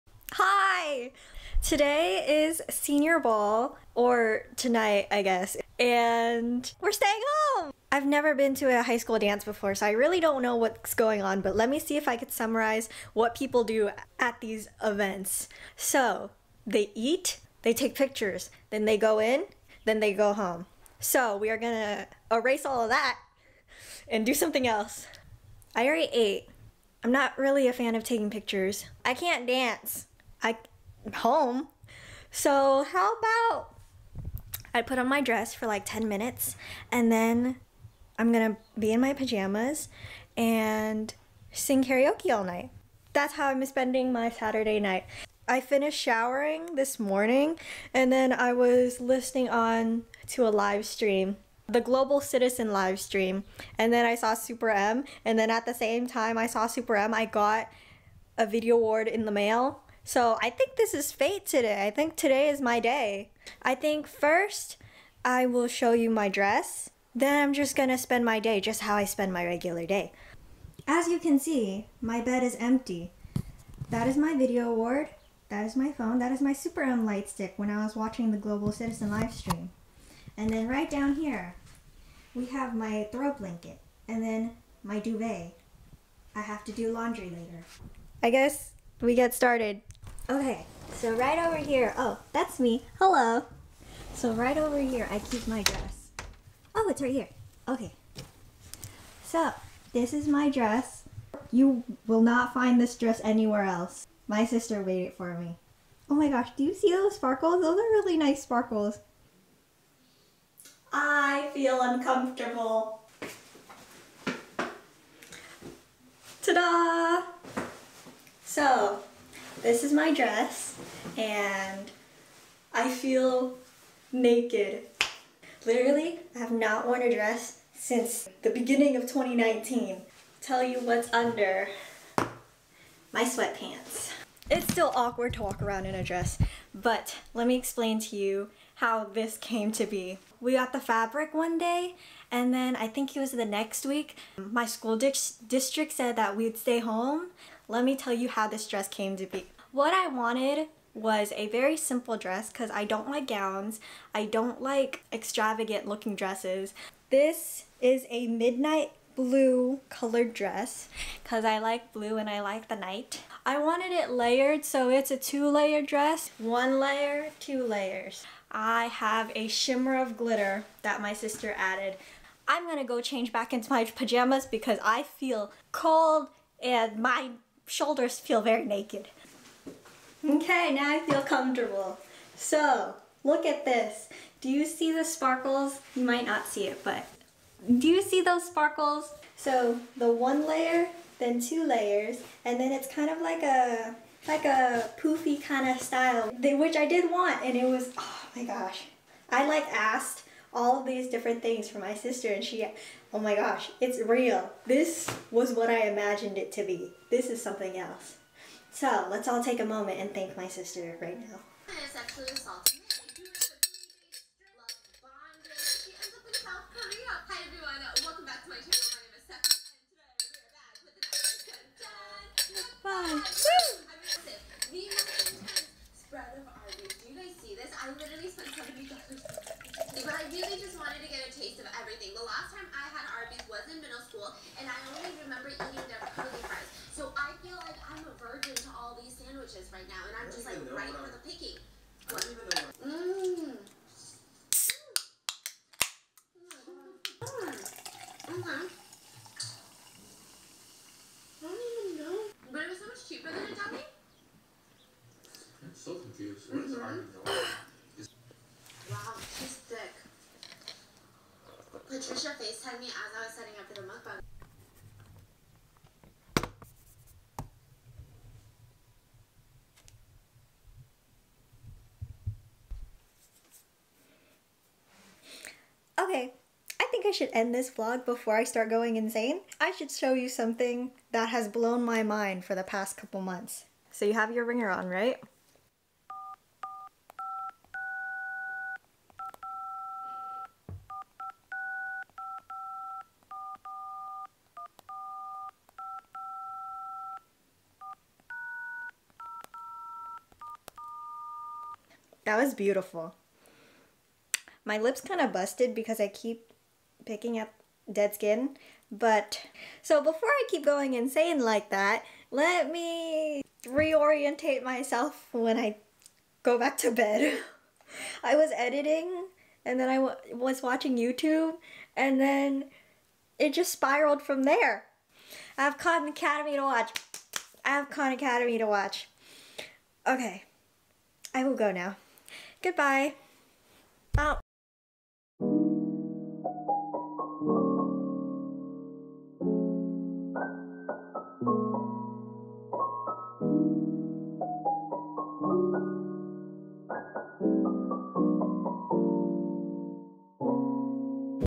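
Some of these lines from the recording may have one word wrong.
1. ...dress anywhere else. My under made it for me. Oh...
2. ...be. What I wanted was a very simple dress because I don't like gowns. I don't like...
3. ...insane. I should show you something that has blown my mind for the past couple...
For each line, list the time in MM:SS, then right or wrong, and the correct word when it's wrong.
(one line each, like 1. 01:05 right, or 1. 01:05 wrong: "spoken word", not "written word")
1. 01:42 wrong: "sister", not "under"
2. 02:29 right
3. 04:38 right.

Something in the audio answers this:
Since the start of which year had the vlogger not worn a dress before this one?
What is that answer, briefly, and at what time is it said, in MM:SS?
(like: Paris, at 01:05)
2019, at 02:09.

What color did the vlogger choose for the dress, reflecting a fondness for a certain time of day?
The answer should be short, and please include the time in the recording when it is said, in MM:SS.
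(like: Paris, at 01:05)
midnight blue, at 02:38.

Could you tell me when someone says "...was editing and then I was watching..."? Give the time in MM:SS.
05:18.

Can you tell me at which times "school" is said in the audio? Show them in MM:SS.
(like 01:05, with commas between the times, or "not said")
00:08, 02:24.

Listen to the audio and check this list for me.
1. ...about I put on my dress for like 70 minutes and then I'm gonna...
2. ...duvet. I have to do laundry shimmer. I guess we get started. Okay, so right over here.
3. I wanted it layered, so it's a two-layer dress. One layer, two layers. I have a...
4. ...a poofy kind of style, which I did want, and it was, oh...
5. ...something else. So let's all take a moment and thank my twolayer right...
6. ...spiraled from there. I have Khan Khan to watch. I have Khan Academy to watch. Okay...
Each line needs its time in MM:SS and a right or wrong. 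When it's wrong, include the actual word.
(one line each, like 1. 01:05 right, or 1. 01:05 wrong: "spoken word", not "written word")
1. 00:33 wrong: "10", not "70"
2. 01:24 wrong: "later", not "shimmer"
3. 02:43 right
4. 03:14 right
5. 03:27 wrong: "sister", not "twolayer"
6. 05:23 wrong: "Academy", not "Khan".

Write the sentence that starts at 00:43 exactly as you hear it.
That's how I'm spending my Saturday night.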